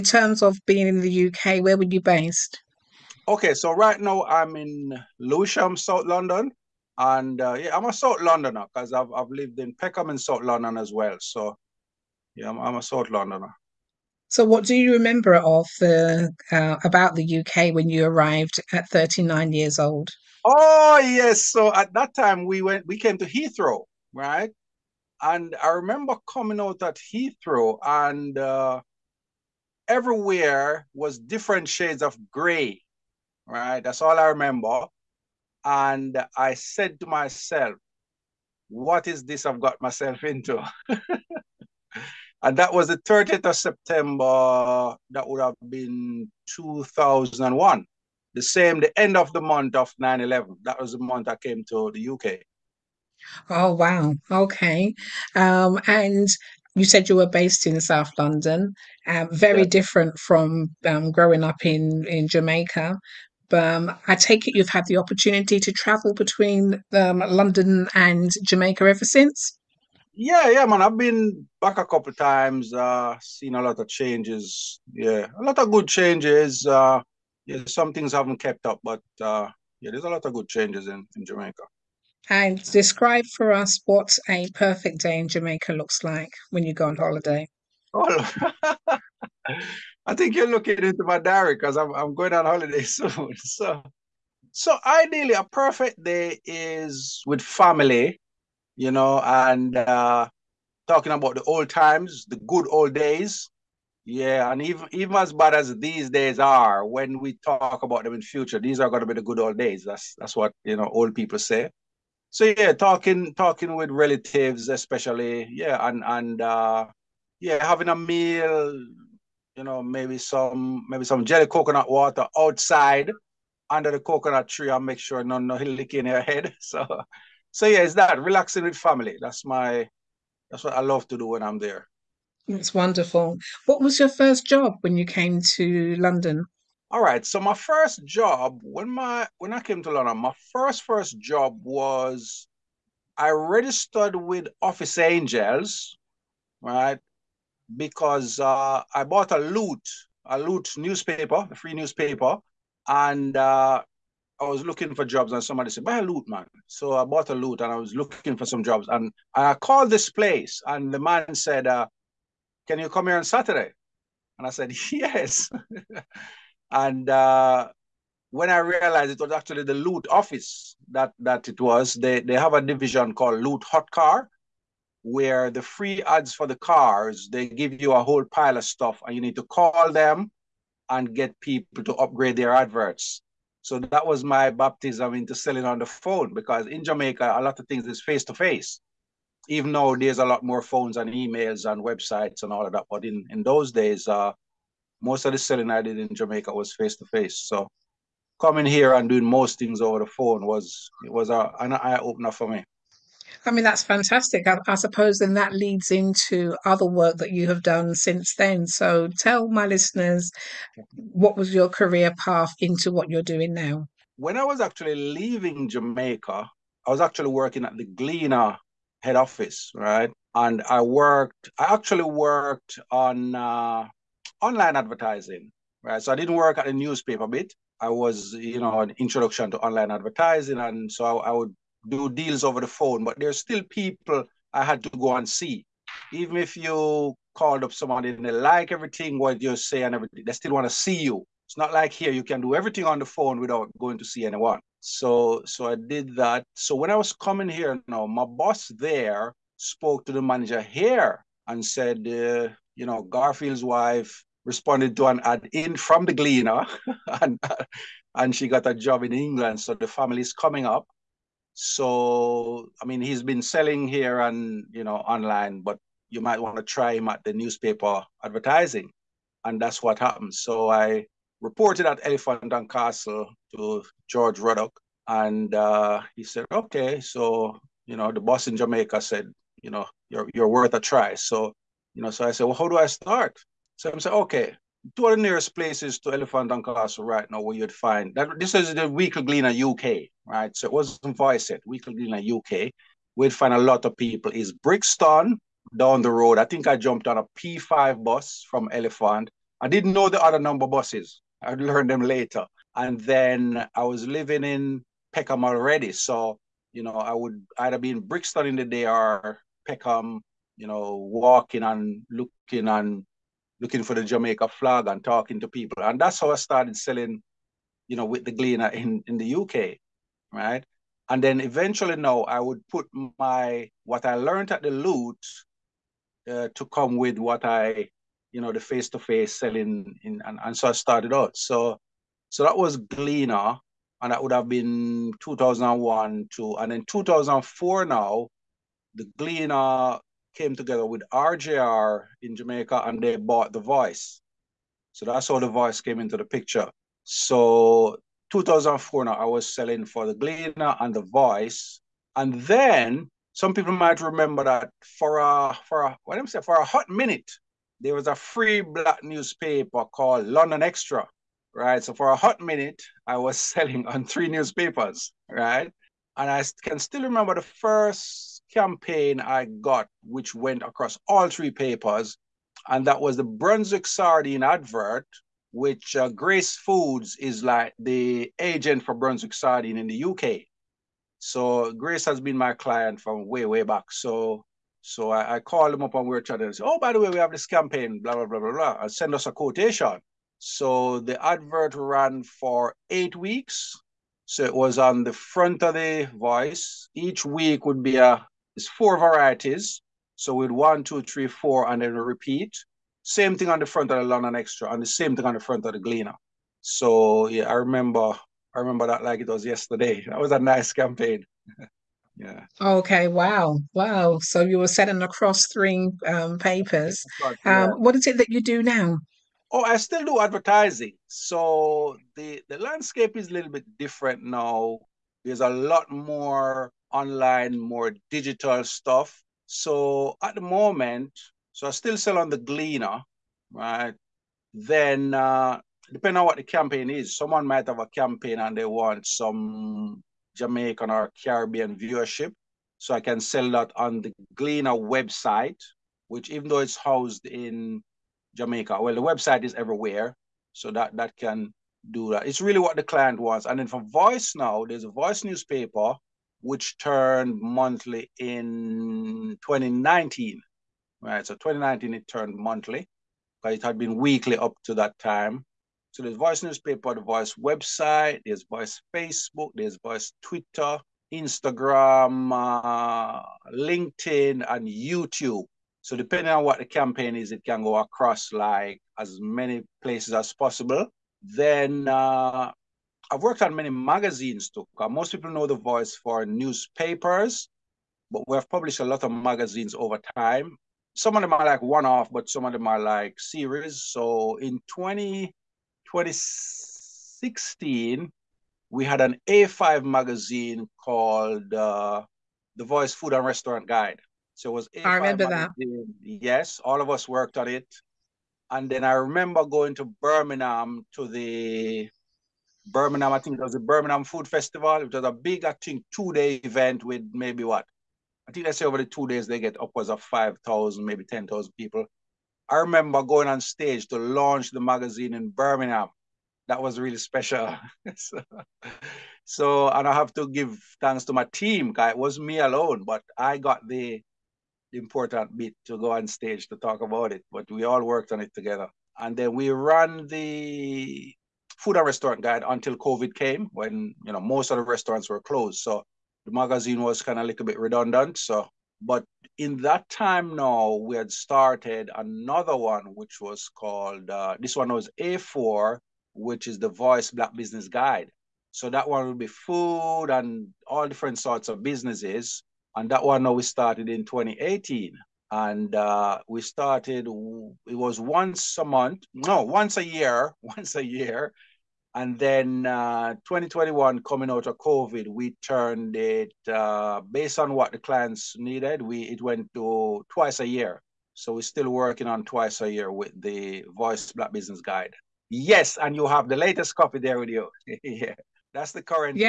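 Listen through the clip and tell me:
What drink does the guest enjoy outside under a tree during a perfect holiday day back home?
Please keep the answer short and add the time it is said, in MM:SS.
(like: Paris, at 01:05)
jelly coconut water, at 02:01.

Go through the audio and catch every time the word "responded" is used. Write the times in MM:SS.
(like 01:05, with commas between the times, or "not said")
04:14.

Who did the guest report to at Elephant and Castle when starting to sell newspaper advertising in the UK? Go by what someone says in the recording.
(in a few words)
George Ruddock.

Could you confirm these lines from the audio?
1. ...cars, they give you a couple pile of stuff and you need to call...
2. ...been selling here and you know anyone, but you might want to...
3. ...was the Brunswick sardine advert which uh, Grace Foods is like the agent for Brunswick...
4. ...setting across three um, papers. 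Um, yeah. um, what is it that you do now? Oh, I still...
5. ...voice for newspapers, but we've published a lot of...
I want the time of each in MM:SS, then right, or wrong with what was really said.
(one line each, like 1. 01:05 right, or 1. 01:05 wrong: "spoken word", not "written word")
1. 02:56 wrong: "whole", not "couple"
2. 04:23 wrong: "online", not "anyone"
3. 06:12 right
4. 06:54 right
5. 08:05 right.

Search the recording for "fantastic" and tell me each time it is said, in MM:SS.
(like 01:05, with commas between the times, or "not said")
03:23.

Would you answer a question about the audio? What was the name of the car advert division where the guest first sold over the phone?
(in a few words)
Loot Hot Car.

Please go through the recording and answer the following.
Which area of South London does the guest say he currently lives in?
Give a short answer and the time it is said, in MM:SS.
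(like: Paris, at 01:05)
Lewisham, at 00:05.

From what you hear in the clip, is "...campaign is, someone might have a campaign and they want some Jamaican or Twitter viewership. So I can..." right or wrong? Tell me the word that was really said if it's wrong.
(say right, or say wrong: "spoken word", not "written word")
wrong: "Caribbean", not "Twitter".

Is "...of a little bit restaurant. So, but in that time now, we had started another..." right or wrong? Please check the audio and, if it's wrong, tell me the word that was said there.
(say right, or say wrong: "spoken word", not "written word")
wrong: "redundant", not "restaurant".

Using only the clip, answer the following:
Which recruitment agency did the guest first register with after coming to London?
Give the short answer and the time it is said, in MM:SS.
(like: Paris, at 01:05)
Office Angels, at 02:24.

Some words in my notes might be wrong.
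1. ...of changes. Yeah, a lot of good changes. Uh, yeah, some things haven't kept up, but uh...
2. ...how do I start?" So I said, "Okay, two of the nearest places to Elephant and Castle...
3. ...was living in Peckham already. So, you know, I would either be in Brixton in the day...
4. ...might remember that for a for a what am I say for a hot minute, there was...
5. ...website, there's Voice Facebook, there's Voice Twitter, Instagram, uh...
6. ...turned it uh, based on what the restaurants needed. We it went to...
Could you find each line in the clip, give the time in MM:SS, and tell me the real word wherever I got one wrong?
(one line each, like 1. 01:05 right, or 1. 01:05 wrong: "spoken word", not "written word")
1. 01:13 right
2. 04:42 right
3. 05:03 right
4. 05:53 right
5. 07:47 right
6. 09:35 wrong: "clients", not "restaurants".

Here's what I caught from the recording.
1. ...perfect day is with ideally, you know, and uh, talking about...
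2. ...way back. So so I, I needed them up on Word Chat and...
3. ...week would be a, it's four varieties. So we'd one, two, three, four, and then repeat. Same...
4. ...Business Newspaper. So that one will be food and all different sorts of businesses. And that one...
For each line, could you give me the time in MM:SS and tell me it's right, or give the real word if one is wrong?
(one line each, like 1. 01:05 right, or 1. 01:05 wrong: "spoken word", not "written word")
1. 01:35 wrong: "family", not "ideally"
2. 06:23 wrong: "called", not "needed"
3. 06:37 right
4. 09:17 wrong: "Guide", not "Newspaper".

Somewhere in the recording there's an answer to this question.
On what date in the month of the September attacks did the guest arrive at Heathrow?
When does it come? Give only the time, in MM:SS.
00:42.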